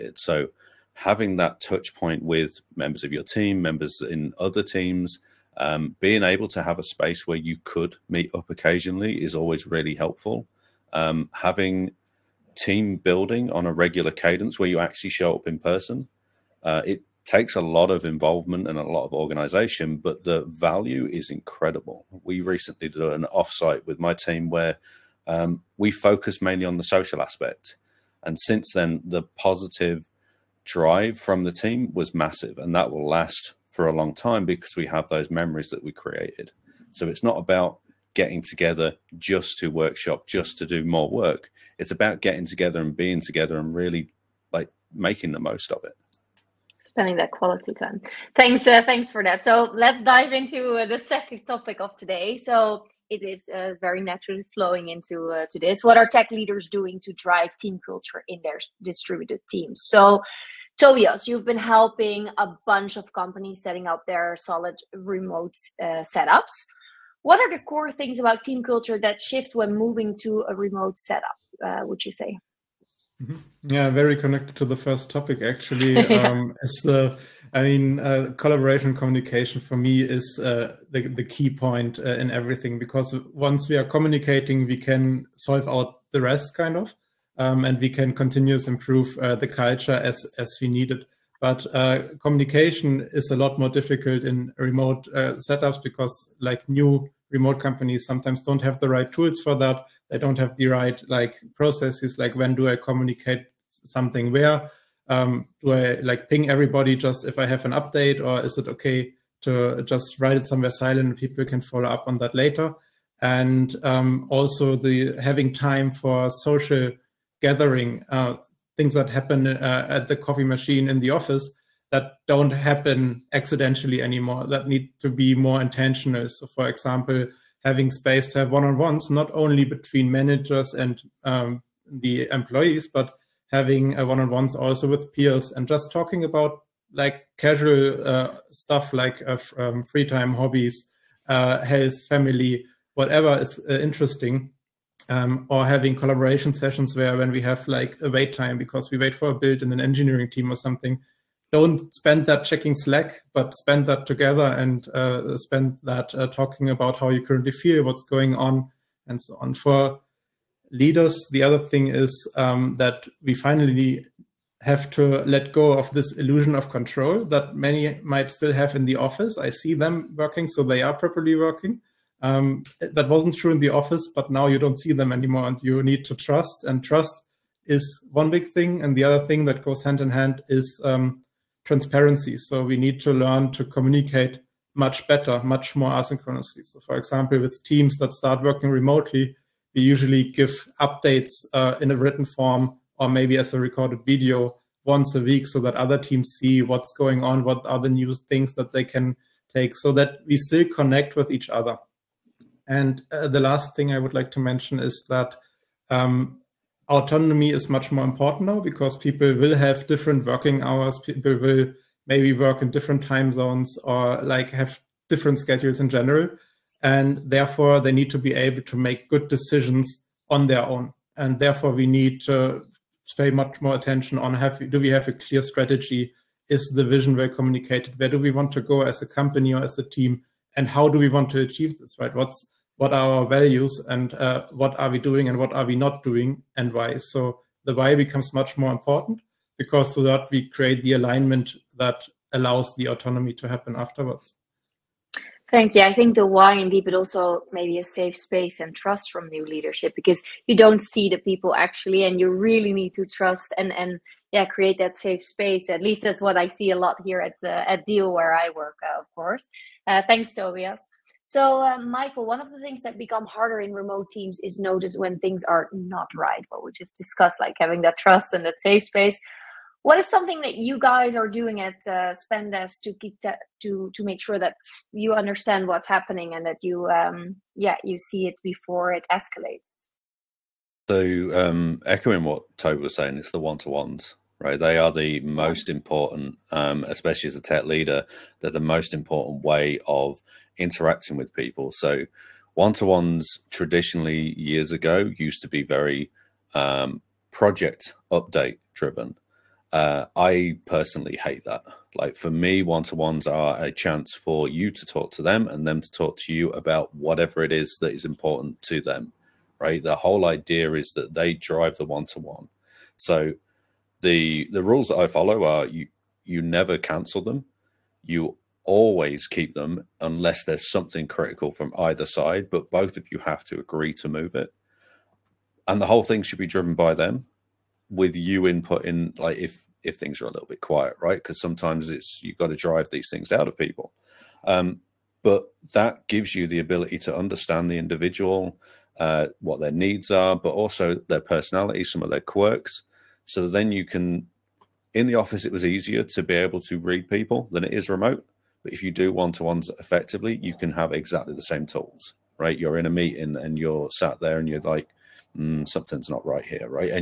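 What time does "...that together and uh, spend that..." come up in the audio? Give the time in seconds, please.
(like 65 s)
153 s.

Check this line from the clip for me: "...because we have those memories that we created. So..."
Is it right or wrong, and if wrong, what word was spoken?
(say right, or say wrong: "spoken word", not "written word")
right.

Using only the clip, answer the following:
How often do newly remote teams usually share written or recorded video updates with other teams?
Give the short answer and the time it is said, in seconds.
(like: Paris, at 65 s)
once a week, at 194 s.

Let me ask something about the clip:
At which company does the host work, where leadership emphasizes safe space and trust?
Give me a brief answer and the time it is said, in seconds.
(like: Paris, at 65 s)
Deel, at 257 s.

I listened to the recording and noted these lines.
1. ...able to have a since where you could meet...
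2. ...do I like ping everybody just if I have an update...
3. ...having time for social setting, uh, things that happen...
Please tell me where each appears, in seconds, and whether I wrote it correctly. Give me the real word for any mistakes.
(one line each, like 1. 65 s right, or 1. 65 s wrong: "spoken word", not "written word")
1. 6 s wrong: "space", not "since"
2. 105 s right
3. 115 s wrong: "gathering", not "setting".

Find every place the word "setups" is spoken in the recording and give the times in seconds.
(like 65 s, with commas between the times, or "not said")
66 s, 70 s, 95 s.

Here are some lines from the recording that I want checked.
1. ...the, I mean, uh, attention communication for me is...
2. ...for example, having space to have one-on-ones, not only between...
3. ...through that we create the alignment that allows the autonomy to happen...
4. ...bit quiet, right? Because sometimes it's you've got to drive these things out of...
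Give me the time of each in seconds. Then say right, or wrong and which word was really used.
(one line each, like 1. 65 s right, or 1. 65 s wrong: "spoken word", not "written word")
1. 76 s wrong: "collaboration", not "attention"
2. 126 s right
3. 239 s right
4. 330 s right.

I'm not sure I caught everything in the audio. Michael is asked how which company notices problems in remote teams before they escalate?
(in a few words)
Spendesk.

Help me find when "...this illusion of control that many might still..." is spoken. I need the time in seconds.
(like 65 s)
165 s.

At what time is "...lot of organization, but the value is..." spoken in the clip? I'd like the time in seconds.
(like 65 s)
18 s.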